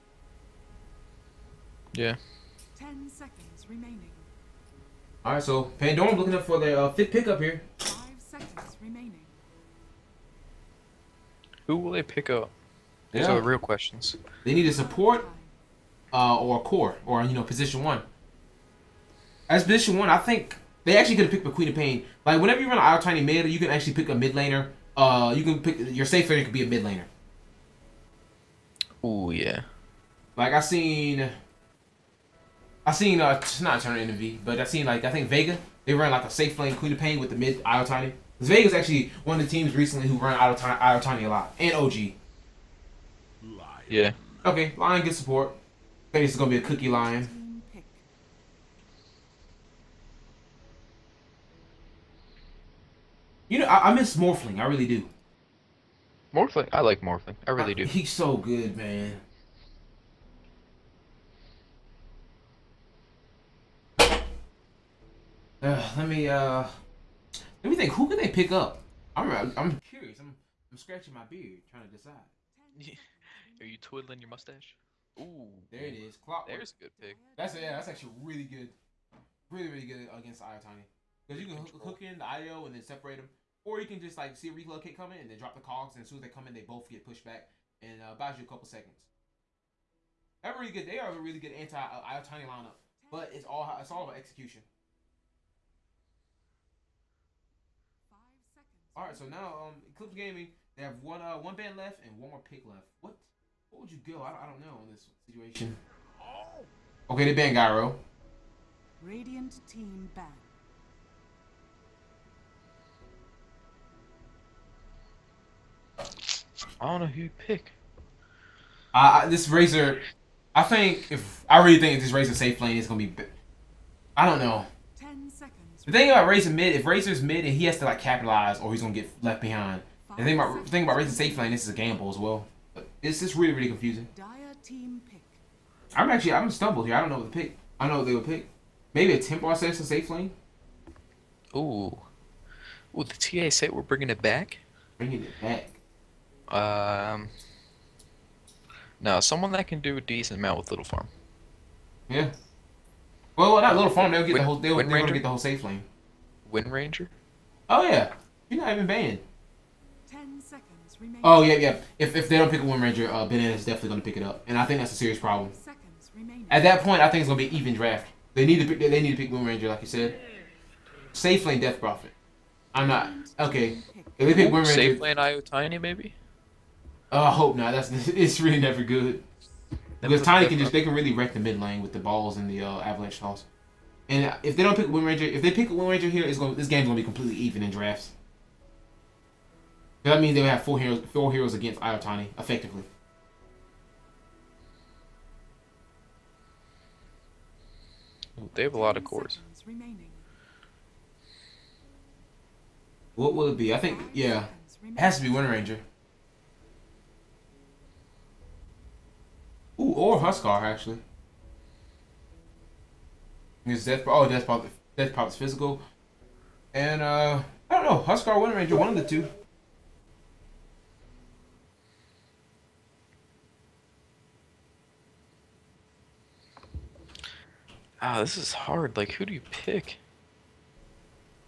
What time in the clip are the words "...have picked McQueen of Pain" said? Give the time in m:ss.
0:21.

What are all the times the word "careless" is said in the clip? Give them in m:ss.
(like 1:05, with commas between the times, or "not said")
not said.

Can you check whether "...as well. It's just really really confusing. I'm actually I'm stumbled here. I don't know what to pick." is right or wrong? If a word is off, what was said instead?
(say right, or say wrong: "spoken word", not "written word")
right.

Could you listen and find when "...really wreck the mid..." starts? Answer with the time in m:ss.
3:00.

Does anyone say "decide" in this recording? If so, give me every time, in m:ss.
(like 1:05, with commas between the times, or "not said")
1:11.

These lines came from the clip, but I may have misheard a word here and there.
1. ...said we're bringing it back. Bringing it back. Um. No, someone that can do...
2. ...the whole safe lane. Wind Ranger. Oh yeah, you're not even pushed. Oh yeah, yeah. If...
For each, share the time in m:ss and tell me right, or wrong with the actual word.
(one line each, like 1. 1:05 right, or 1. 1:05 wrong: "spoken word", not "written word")
1. 2:23 right
2. 2:35 wrong: "banned", not "pushed".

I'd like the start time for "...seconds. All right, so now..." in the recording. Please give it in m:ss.
1:38.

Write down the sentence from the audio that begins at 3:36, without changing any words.
And, uh, I don't know, Huskar, Wind Ranger, one of the two.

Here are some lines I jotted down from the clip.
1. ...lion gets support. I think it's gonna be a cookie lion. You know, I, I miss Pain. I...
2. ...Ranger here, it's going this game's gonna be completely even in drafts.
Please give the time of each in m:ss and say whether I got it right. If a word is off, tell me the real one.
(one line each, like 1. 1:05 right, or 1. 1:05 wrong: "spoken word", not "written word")
1. 0:44 wrong: "Morphling", not "Pain"
2. 3:05 right.